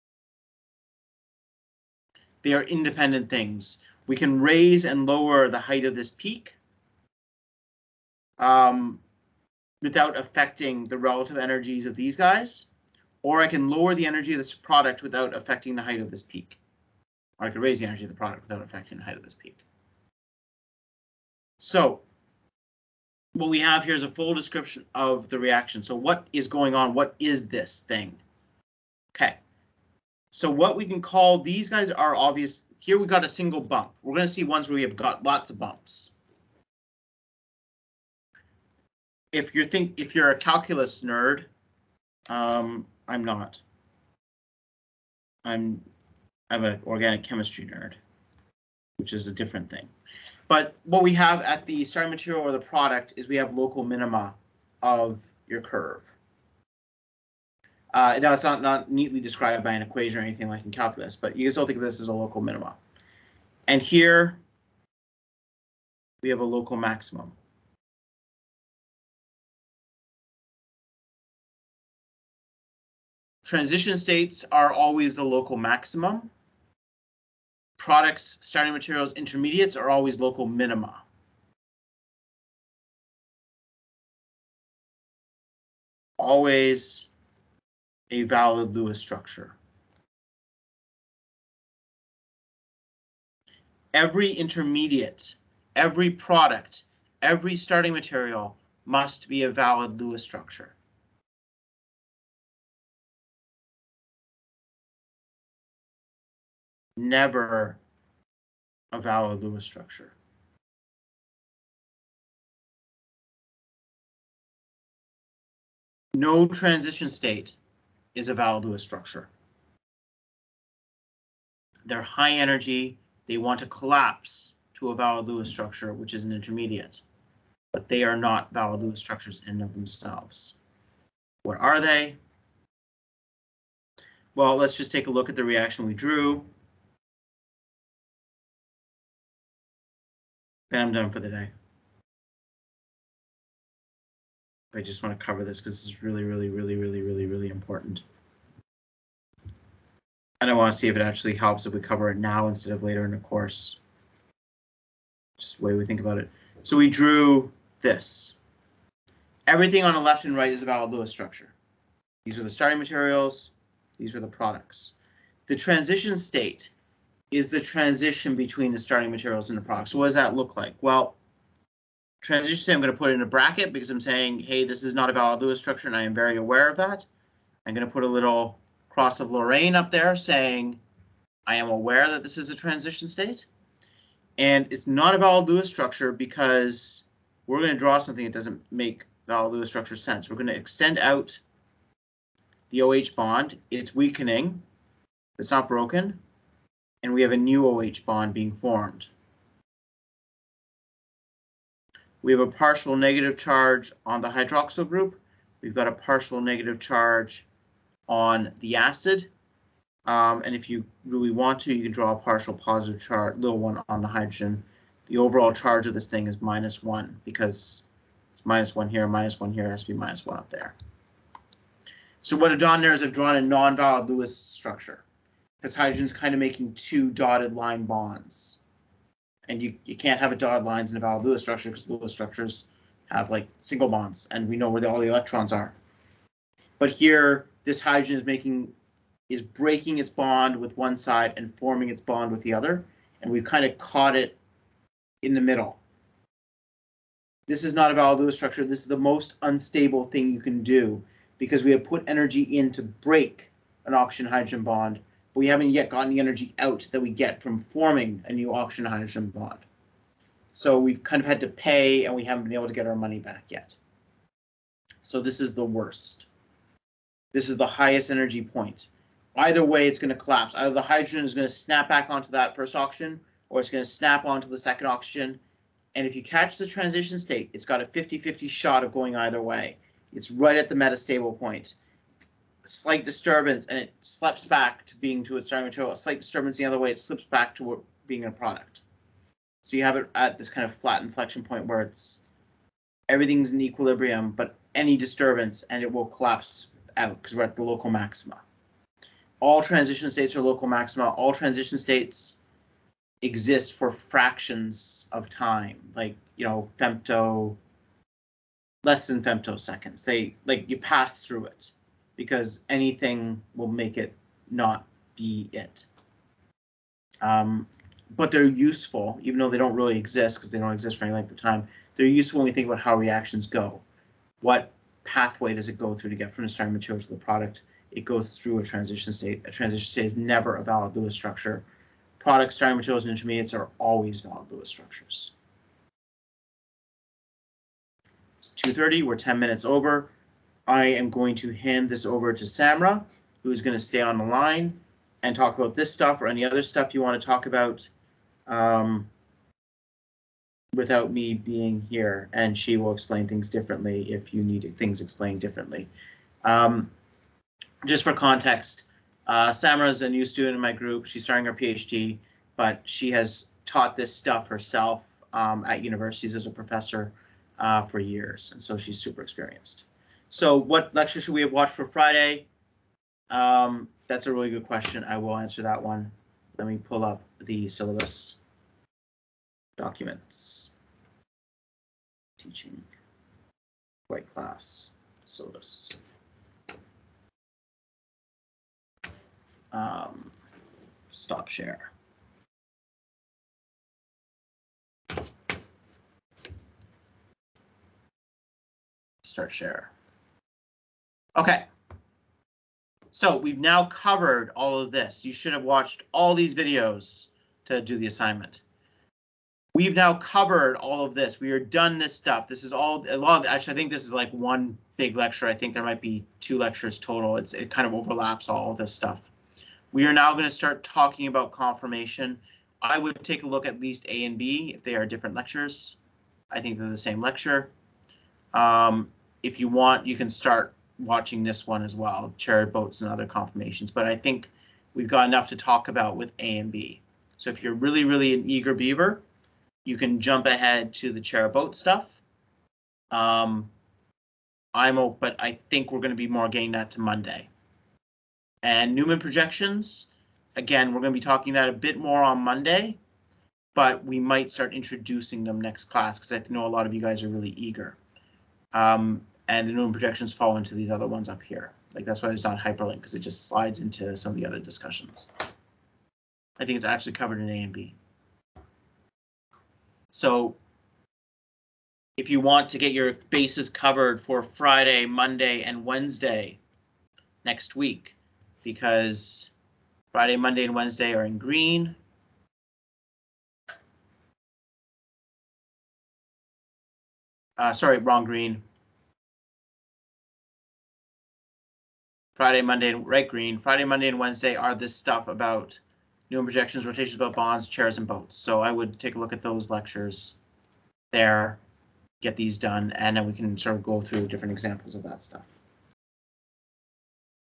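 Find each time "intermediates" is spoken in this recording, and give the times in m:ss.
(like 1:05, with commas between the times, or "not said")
1:19, 1:34, 2:06, 5:33.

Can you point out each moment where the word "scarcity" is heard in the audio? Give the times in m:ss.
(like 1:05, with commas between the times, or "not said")
not said.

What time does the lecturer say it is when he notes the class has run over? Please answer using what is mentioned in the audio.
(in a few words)
2:30.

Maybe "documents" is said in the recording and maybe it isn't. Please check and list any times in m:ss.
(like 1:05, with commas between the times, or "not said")
6:19.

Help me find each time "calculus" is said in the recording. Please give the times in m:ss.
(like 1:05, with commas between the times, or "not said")
0:40, 1:00.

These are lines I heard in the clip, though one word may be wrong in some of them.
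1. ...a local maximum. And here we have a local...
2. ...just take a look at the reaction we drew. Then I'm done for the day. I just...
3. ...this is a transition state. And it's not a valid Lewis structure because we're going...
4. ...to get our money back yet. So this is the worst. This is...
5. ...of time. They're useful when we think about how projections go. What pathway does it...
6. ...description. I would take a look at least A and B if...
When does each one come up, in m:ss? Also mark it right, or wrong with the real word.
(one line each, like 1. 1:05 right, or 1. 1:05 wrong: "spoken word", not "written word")
1. 1:02 wrong: "minimum", not "maximum"
2. 2:14 right
3. 3:02 right
4. 4:22 right
5. 5:21 wrong: "reactions", not "projections"
6. 7:01 wrong: "conformation", not "description".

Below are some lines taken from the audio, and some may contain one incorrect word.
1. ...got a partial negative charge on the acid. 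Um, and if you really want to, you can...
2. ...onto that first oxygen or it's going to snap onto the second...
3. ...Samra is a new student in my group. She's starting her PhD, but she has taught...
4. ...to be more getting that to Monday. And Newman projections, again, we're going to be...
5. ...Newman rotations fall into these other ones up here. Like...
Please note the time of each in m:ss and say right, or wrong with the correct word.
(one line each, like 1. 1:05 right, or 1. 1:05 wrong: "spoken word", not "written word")
1. 3:25 right
2. 4:32 right
3. 5:59 right
4. 7:26 right
5. 7:39 wrong: "projections", not "rotations".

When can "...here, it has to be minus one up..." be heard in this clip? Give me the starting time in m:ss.
3:39.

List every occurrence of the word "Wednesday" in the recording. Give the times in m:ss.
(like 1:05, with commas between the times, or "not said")
7:55, 8:00, 8:14.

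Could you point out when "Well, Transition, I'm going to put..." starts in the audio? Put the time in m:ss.
2:50.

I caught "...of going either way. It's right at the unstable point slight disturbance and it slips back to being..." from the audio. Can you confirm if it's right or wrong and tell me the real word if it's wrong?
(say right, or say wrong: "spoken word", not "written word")
wrong: "metastable", not "unstable".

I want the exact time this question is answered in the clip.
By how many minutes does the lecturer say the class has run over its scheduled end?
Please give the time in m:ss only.
5:39.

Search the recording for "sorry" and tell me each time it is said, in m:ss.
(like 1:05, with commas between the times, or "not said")
8:07.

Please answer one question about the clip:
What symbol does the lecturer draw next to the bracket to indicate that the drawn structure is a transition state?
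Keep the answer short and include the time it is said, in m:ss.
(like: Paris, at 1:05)
cross of Lorraine, at 2:58.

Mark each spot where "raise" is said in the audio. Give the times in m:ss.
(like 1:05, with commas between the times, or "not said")
0:04, 0:17.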